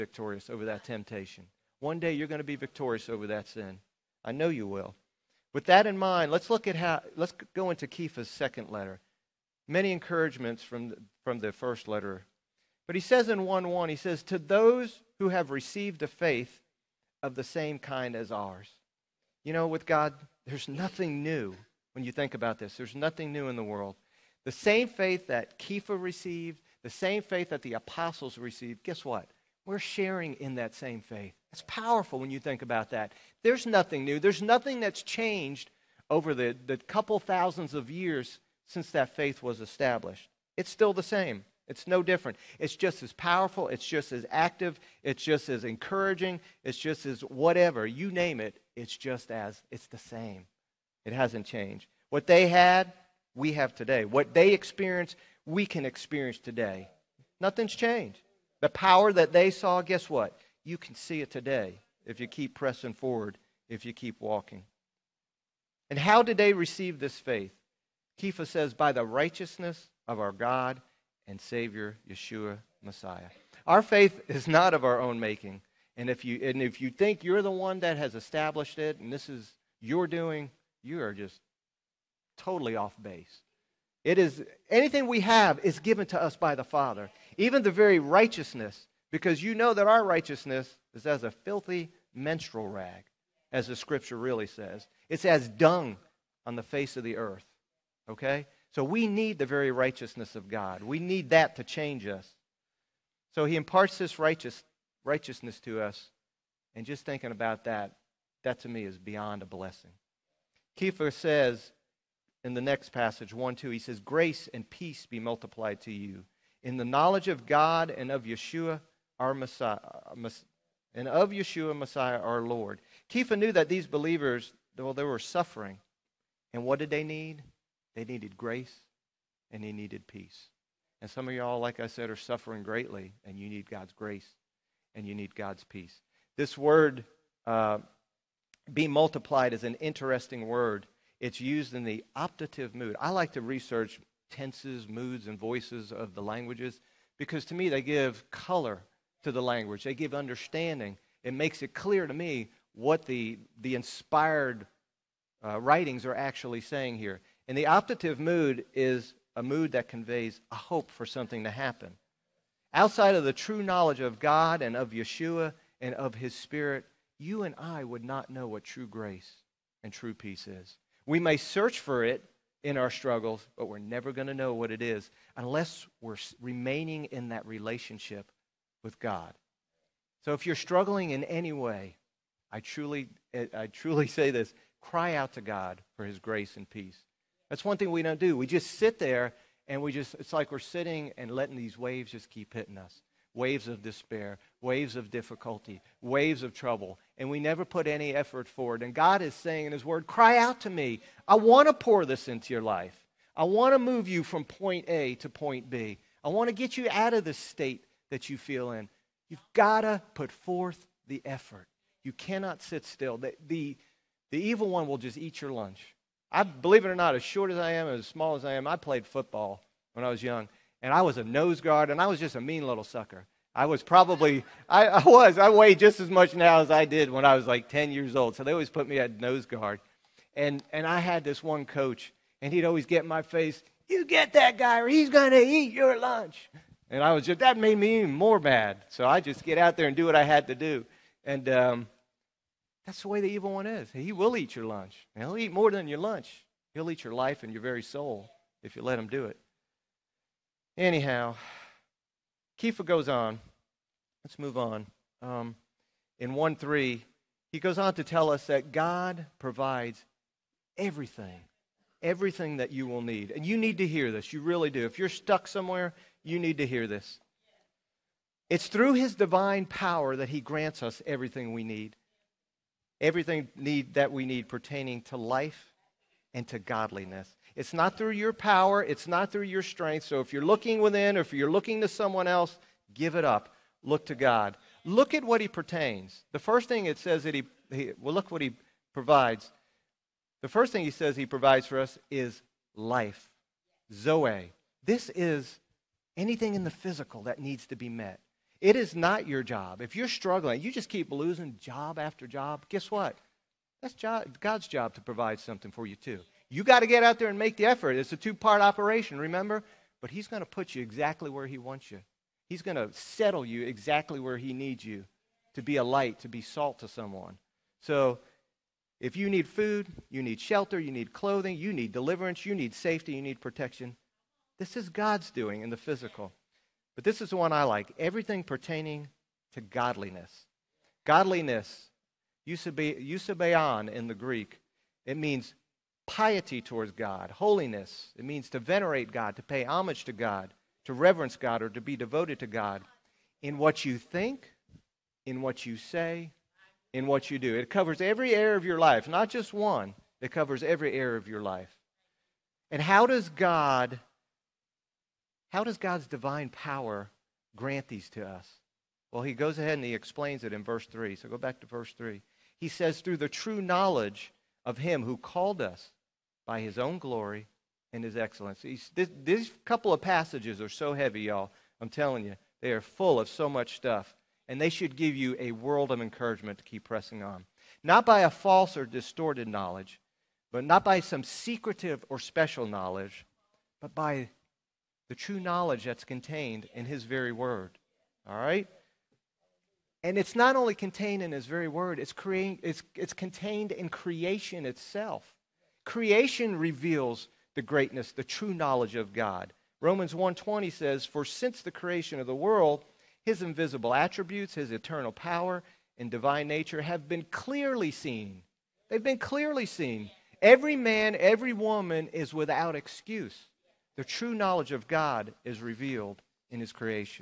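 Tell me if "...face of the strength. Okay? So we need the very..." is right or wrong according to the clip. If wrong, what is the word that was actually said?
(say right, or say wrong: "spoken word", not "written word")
wrong: "earth", not "strength".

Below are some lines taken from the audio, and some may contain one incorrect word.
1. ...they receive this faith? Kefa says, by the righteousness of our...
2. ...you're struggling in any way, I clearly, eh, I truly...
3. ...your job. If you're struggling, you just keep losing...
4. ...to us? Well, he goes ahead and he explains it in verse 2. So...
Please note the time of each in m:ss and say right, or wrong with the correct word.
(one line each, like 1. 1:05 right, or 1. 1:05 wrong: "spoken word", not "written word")
1. 1:06 right
2. 3:00 wrong: "truly", not "clearly"
3. 4:59 right
4. 5:58 wrong: "3", not "2".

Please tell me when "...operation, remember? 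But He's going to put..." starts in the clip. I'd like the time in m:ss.
5:08.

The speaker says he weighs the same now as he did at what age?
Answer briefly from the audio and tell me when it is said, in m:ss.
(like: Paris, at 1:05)
10, at 3:47.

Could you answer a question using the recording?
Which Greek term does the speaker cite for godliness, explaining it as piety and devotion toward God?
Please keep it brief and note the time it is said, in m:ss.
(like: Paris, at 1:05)
Eusebeon, at 5:32.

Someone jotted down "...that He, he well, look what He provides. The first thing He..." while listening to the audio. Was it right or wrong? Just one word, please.
right.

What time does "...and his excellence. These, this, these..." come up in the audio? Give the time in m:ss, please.
6:07.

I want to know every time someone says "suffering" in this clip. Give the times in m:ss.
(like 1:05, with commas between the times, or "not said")
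2:05, 2:12.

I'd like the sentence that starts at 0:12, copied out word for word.
But he says in 1 1, he says, To those who have received a faith of the same kind as ours.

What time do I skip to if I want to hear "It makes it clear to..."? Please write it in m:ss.
2:31.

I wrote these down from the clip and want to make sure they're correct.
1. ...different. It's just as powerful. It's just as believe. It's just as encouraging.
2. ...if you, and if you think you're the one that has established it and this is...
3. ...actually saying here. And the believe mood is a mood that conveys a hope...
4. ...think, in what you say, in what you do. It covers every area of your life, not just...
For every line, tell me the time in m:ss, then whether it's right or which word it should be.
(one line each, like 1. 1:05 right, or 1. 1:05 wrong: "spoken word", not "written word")
1. 0:42 wrong: "active", not "believe"
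2. 1:16 right
3. 2:36 wrong: "optative", not "believe"
4. 5:43 right.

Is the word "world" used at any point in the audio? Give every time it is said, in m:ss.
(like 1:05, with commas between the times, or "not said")
0:23, 6:15, 6:42.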